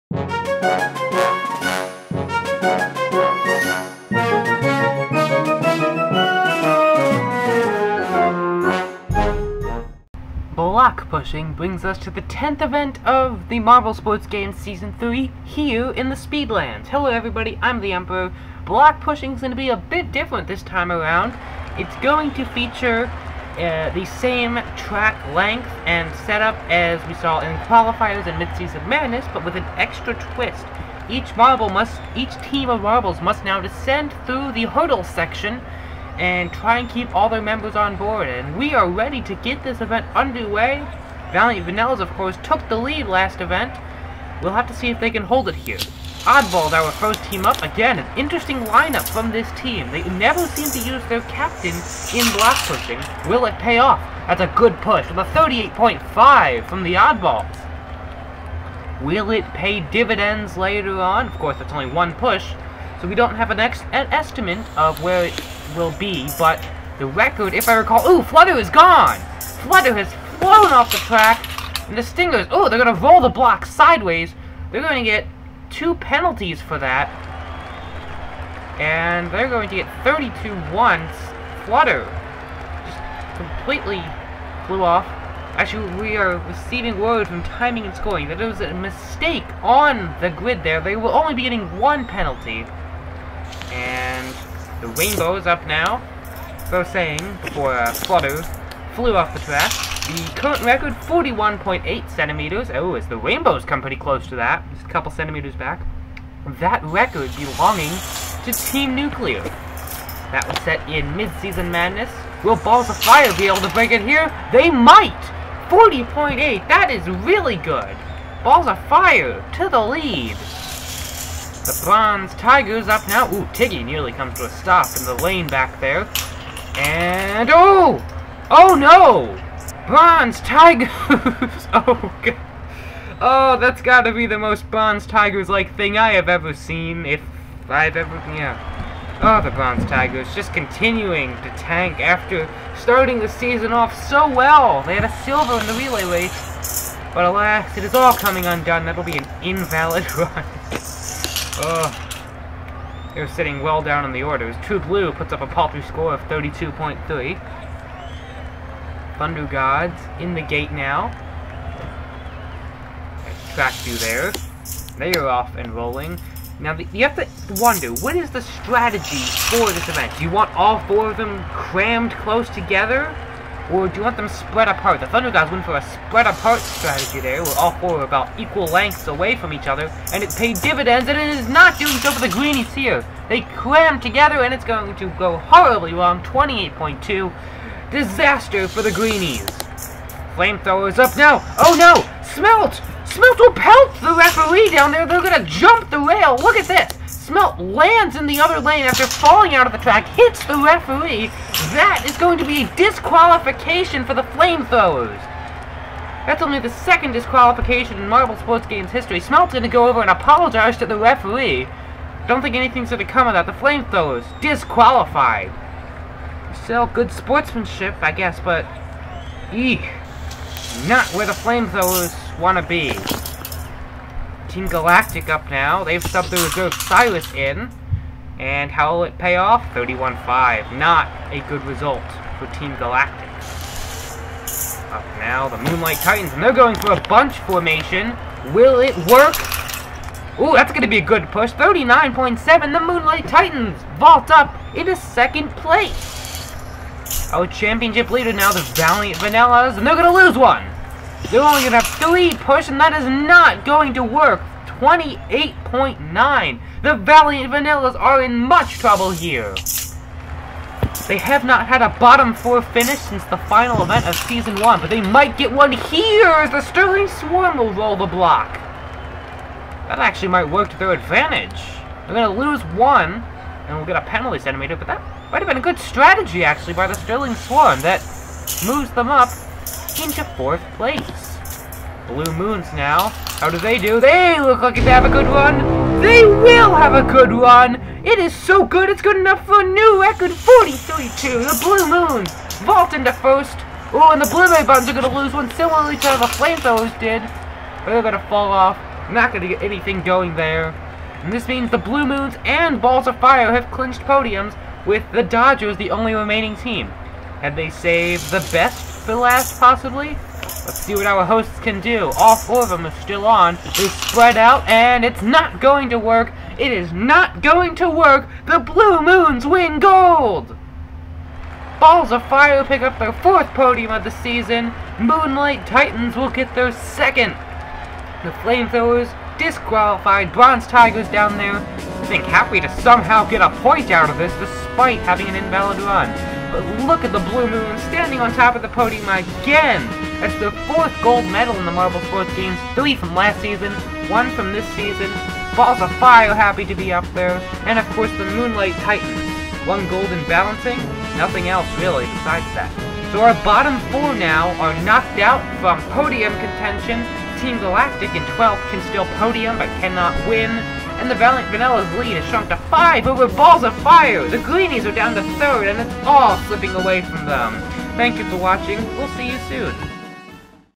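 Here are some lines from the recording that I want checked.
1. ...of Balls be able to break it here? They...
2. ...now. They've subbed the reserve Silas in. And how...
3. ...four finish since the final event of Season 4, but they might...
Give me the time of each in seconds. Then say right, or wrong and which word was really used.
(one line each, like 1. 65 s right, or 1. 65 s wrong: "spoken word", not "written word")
1. 112 s wrong: "Fire", not "Balls"
2. 225 s right
3. 262 s wrong: "1", not "4".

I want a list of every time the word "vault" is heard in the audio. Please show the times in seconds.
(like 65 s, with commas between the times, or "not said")
243 s, 292 s.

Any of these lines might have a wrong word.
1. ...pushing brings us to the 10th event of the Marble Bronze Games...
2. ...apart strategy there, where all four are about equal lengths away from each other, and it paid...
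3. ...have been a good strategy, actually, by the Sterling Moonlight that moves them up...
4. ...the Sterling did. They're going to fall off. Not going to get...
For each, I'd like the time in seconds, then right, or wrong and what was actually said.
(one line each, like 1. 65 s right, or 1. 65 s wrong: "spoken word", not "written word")
1. 11 s wrong: "Sports", not "Bronze"
2. 176 s right
3. 275 s wrong: "Swarm", not "Moonlight"
4. 296 s wrong: "Flamethrowers", not "Sterling".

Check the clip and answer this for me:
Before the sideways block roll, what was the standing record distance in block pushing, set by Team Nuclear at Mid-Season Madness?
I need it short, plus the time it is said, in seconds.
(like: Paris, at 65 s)
41.8 centimeters, at 100 s.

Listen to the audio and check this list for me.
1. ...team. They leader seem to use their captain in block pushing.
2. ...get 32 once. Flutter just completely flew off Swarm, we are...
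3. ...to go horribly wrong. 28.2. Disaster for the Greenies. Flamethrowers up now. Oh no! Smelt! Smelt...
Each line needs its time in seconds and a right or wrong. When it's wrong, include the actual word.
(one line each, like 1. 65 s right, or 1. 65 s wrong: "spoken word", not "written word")
1. 49 s wrong: "never", not "leader"
2. 79 s wrong: "Actually", not "Swarm"
3. 184 s right.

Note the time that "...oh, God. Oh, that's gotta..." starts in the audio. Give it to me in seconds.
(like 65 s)
131 s.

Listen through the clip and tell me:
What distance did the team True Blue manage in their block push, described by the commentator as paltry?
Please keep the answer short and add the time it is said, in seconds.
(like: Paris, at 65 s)
32.3, at 156 s.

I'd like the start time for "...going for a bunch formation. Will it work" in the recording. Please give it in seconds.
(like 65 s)
236 s.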